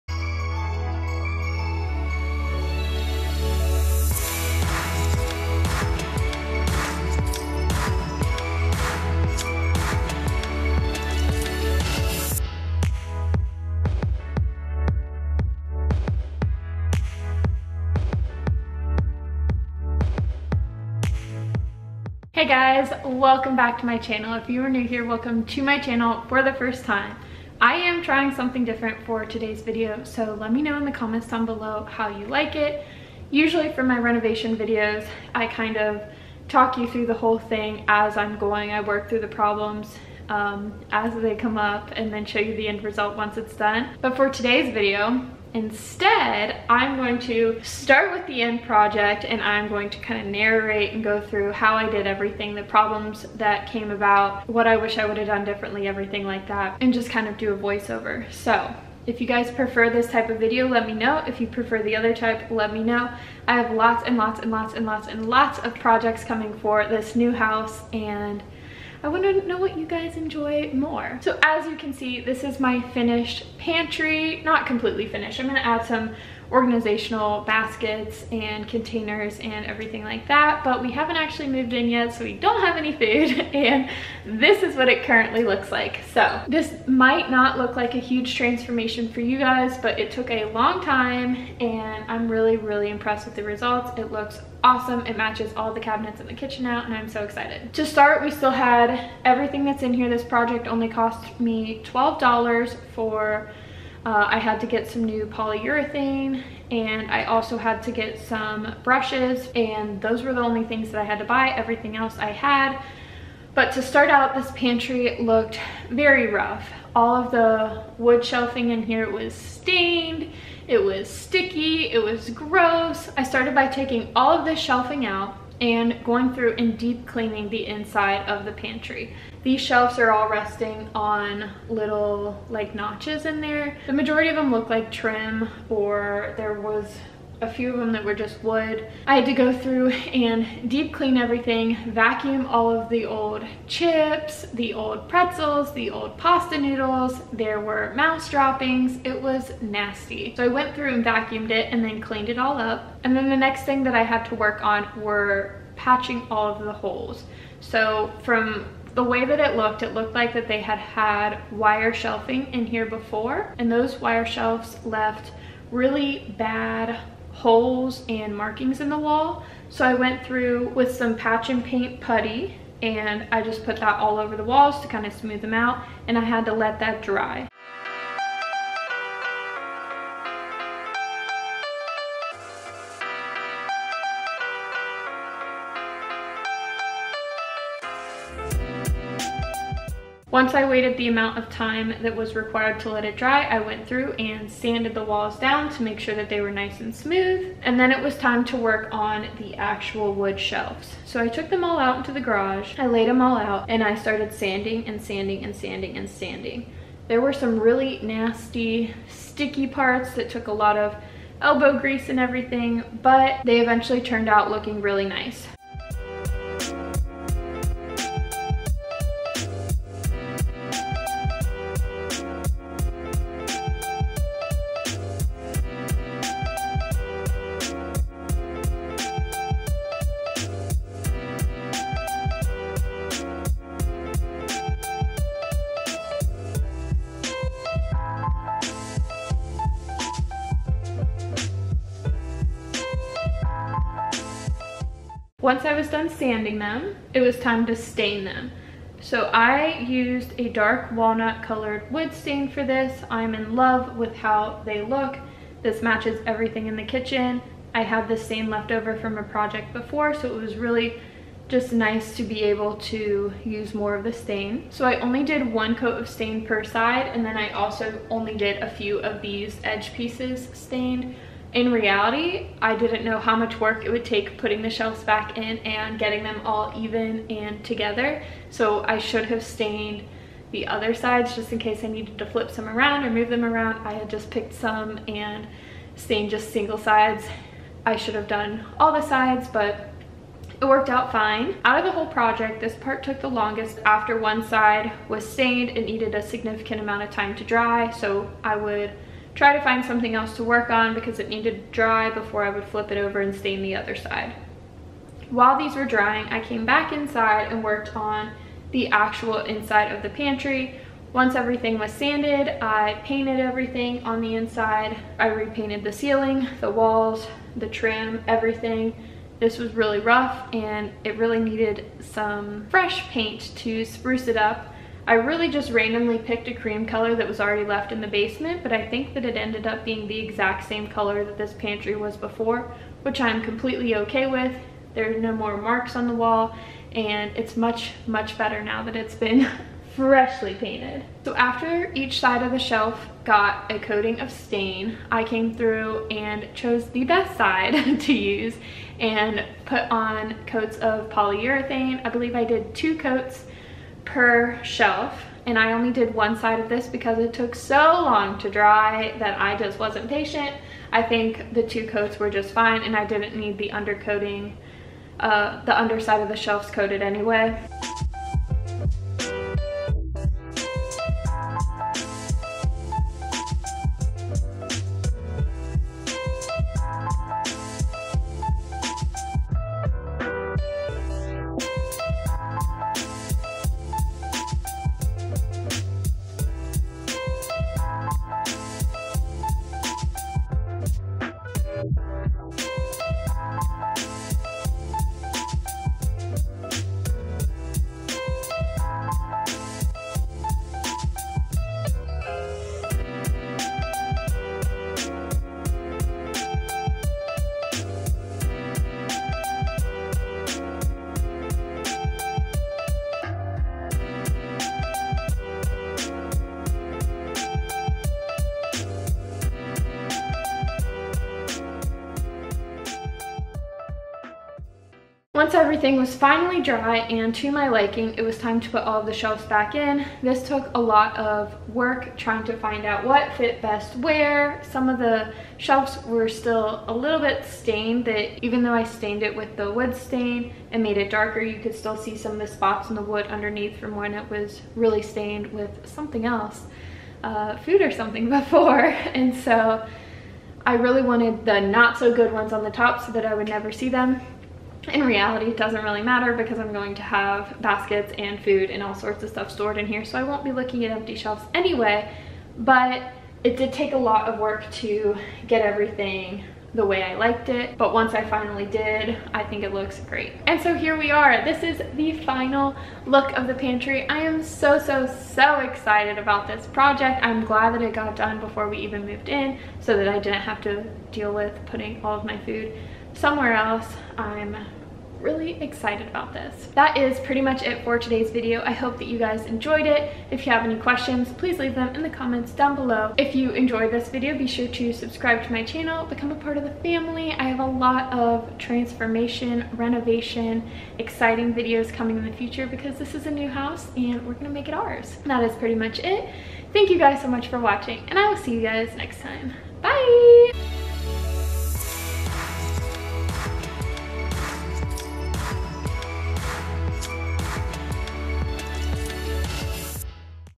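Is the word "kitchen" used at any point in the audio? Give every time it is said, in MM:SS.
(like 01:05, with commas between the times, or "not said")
01:36, 04:16.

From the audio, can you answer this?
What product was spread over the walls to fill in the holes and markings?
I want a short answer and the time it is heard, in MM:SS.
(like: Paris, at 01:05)
Patch and paint putty, at 02:51.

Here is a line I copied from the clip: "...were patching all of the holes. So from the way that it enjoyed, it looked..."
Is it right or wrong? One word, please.
wrong.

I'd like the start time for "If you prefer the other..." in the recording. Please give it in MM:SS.
01:01.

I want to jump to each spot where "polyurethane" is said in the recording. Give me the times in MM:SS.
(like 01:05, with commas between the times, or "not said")
01:45, 05:51.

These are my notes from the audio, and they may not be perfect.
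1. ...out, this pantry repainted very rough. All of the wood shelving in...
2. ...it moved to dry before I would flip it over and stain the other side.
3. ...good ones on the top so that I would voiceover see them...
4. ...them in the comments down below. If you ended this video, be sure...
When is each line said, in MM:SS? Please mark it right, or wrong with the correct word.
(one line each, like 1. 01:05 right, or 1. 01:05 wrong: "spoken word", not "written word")
1. 01:54 wrong: "looked", not "repainted"
2. 05:01 wrong: "needed", not "moved"
3. 07:32 wrong: "never", not "voiceover"
4. 08:11 wrong: "enjoyed", not "ended".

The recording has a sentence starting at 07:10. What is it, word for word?
This took a lot of work trying to find out what fit best where.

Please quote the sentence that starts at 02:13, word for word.
The majority of them look like trim or there was a few of them that were just wood.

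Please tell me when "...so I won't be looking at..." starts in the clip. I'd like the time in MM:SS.
07:40.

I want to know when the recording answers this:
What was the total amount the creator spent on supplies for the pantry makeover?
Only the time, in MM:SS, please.
01:41.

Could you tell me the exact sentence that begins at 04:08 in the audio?
So I used a dark walnut colored wood stain for this.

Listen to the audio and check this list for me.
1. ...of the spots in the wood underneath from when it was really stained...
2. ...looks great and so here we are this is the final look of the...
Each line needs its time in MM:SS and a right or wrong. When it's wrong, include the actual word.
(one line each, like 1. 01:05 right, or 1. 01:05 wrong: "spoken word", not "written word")
1. 07:22 right
2. 07:49 right.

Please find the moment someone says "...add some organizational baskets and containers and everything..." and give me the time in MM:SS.
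01:15.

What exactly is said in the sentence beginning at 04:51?
Out of the whole project, this part took the longest after one side was stained.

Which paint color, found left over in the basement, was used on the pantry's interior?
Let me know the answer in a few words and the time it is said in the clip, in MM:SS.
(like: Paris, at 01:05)
Cream, at 05:26.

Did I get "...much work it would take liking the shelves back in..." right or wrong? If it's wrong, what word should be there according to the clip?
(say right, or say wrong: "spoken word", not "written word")
wrong: "putting", not "liking".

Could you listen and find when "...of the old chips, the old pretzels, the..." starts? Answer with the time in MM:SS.
02:22.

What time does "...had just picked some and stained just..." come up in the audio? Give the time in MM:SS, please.
04:43.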